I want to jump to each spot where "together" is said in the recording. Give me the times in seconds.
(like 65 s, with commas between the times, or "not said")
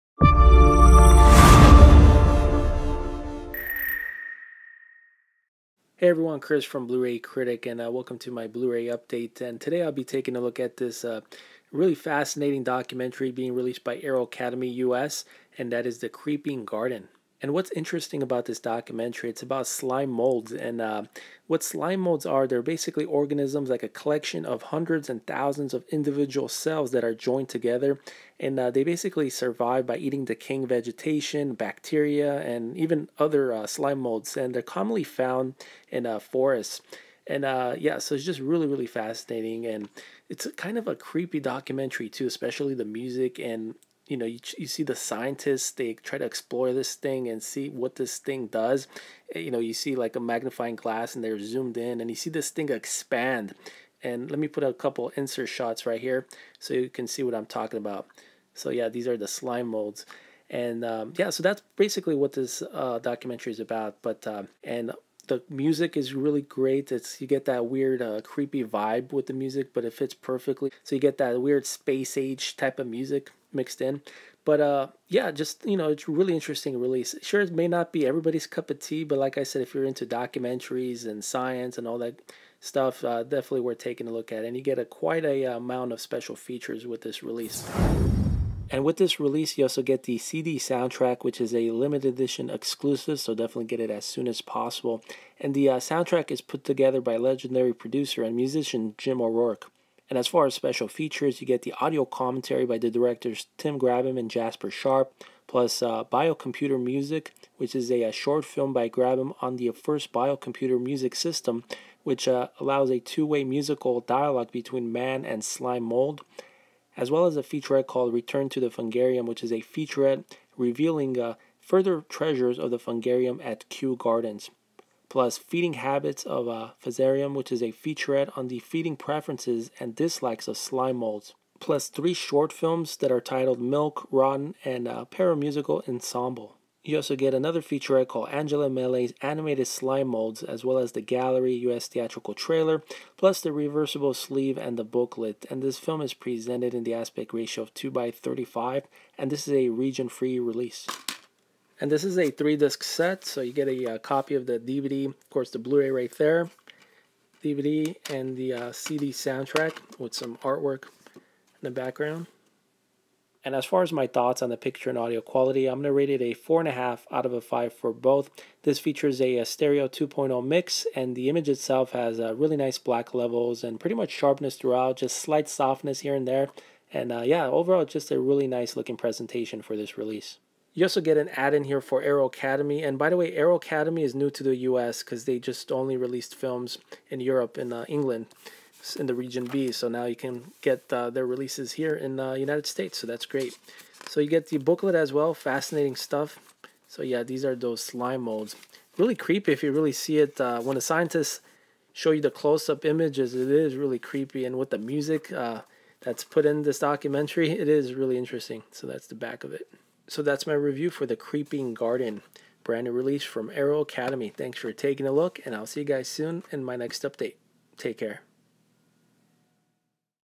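27 s, 96 s.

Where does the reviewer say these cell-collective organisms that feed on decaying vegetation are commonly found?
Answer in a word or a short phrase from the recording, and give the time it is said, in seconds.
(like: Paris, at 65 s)
Forests, at 36 s.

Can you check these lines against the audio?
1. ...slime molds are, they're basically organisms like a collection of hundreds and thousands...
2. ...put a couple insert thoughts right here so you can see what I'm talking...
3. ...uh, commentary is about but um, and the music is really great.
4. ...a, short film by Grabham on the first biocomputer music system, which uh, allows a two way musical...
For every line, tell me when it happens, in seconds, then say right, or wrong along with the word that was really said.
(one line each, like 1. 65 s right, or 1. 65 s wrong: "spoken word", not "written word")
1. 21 s right
2. 54 s wrong: "shots", not "thoughts"
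3. 62 s wrong: "documentary", not "commentary"
4. 108 s right.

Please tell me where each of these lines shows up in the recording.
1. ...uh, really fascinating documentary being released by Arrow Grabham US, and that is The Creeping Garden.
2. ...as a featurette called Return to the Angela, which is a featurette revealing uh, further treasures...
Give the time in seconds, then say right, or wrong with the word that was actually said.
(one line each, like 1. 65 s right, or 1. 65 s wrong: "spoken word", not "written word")
1. 11 s wrong: "Academy", not "Grabham"
2. 117 s wrong: "Fungarium", not "Angela".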